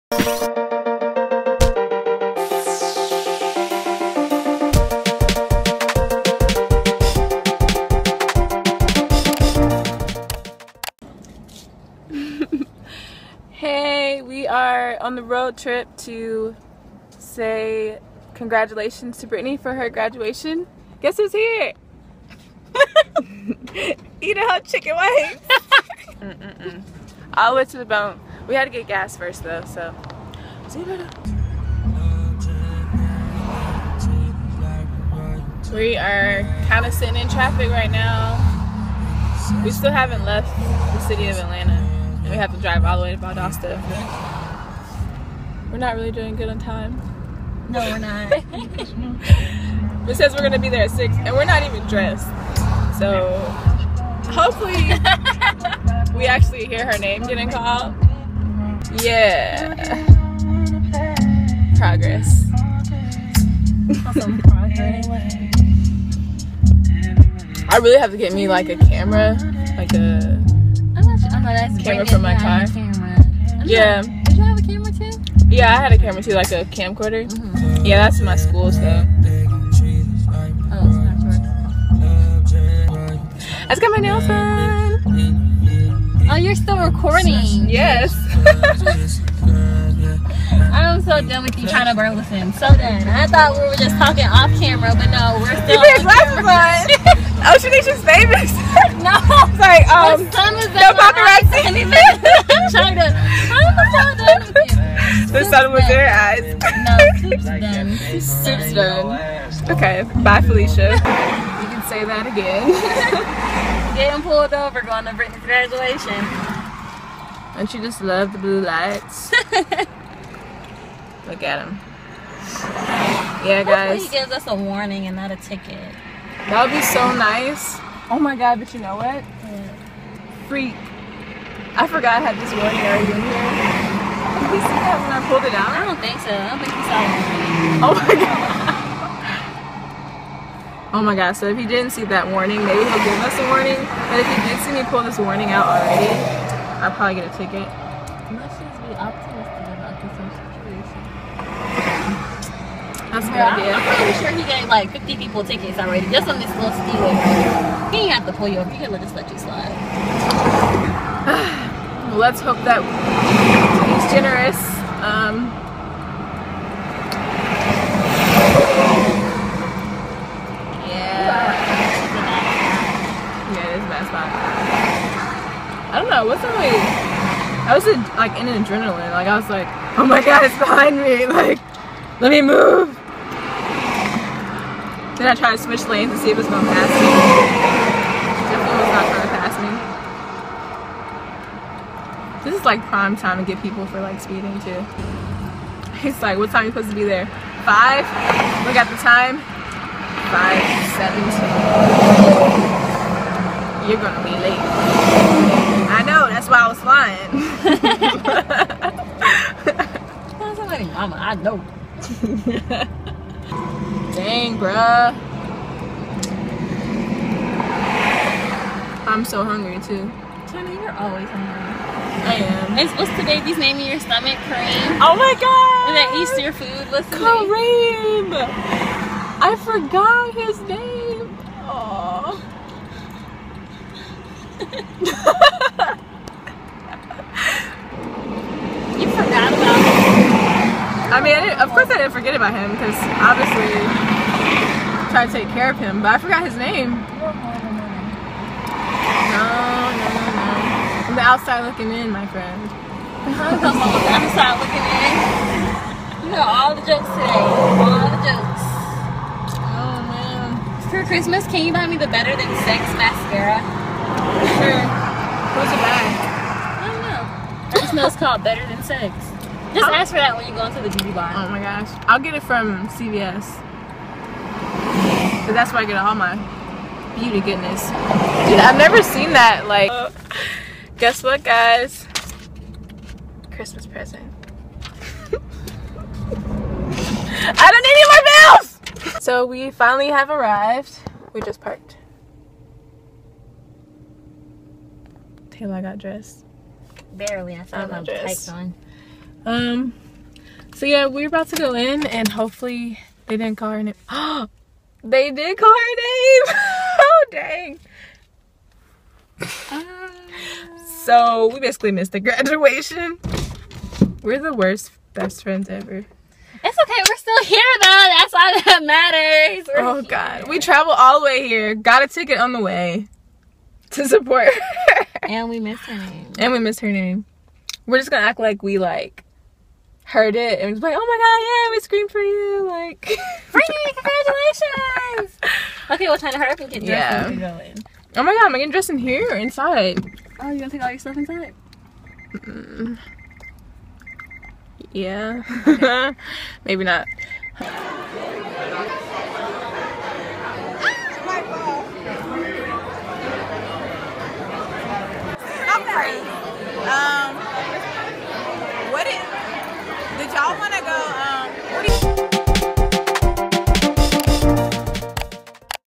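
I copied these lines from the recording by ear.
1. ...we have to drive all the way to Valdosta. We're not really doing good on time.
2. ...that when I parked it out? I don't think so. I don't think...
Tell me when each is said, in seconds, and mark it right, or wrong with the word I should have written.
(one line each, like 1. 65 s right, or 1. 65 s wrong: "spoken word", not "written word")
1. 42 s right
2. 134 s wrong: "pulled", not "parked".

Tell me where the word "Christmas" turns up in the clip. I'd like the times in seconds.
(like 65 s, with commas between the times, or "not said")
261 s, 283 s.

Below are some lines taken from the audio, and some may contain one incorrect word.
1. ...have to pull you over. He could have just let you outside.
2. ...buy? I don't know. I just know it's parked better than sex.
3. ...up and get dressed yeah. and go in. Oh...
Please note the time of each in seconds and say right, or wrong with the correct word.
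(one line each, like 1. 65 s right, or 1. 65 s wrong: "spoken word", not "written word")
1. 158 s wrong: "slide", not "outside"
2. 265 s wrong: "called", not "parked"
3. 336 s right.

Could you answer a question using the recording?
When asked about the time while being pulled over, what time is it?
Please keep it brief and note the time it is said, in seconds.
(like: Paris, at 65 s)
5:17, at 200 s.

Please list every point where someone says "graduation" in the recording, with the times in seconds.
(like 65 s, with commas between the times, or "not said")
19 s, 115 s, 312 s.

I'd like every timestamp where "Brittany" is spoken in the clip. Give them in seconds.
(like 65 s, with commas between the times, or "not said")
19 s, 115 s, 333 s.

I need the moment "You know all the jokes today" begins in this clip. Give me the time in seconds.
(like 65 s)
256 s.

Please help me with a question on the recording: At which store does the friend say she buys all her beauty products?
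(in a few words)
CVS.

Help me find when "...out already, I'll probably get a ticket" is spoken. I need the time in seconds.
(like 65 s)
145 s.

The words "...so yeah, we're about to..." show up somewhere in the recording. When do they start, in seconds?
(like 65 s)
300 s.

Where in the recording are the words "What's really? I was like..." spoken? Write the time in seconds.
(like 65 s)
176 s.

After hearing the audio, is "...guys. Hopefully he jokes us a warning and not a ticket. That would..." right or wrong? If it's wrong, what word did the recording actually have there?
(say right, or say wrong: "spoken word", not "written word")
wrong: "gives", not "jokes".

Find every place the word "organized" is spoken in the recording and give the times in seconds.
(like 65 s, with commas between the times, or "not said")
not said.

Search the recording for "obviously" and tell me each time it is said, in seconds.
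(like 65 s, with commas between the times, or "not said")
243 s.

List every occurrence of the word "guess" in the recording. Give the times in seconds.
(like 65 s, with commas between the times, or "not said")
21 s, 280 s.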